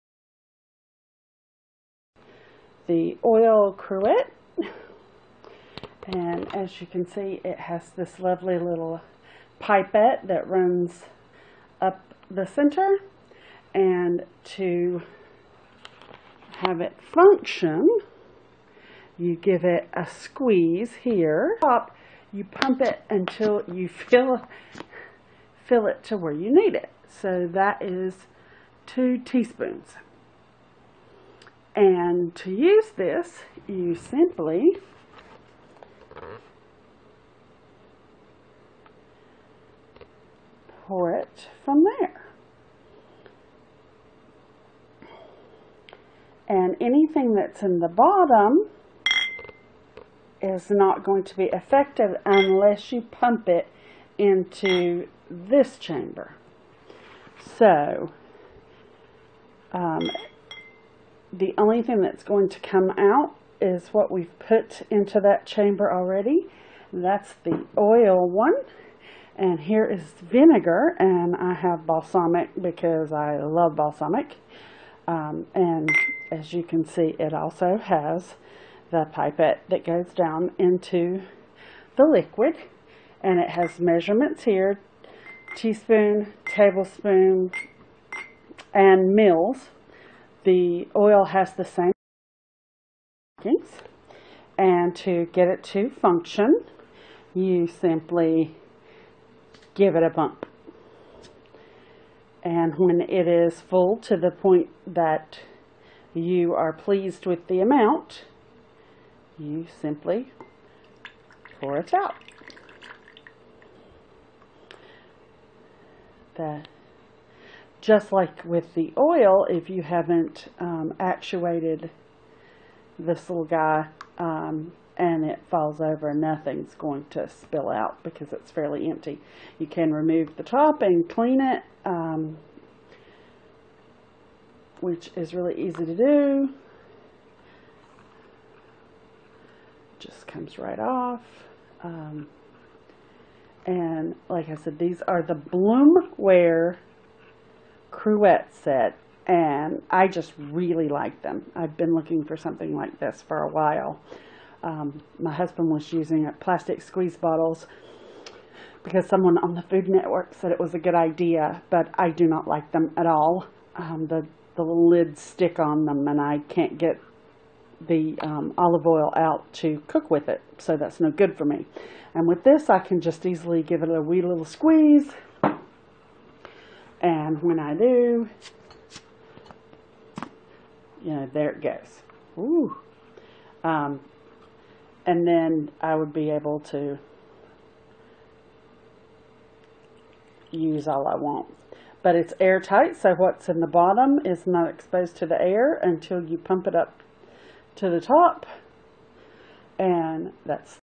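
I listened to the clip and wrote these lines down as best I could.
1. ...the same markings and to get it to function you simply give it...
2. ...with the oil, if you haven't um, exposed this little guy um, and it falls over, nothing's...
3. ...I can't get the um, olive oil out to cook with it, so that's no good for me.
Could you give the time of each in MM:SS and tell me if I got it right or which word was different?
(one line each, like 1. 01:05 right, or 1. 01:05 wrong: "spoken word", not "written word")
1. 01:31 right
2. 01:58 wrong: "actuated", not "exposed"
3. 02:46 right.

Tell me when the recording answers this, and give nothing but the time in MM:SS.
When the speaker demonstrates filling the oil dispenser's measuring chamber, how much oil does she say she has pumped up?
00:28.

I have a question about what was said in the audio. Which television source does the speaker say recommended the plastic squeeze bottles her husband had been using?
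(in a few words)
Food Network.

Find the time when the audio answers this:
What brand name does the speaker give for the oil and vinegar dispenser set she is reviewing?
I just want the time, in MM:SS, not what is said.
02:25.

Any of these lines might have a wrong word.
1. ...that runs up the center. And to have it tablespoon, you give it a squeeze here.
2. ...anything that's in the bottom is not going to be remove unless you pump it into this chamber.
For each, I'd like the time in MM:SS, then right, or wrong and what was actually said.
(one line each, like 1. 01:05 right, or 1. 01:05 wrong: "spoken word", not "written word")
1. 00:10 wrong: "function", not "tablespoon"
2. 00:46 wrong: "effective", not "remove".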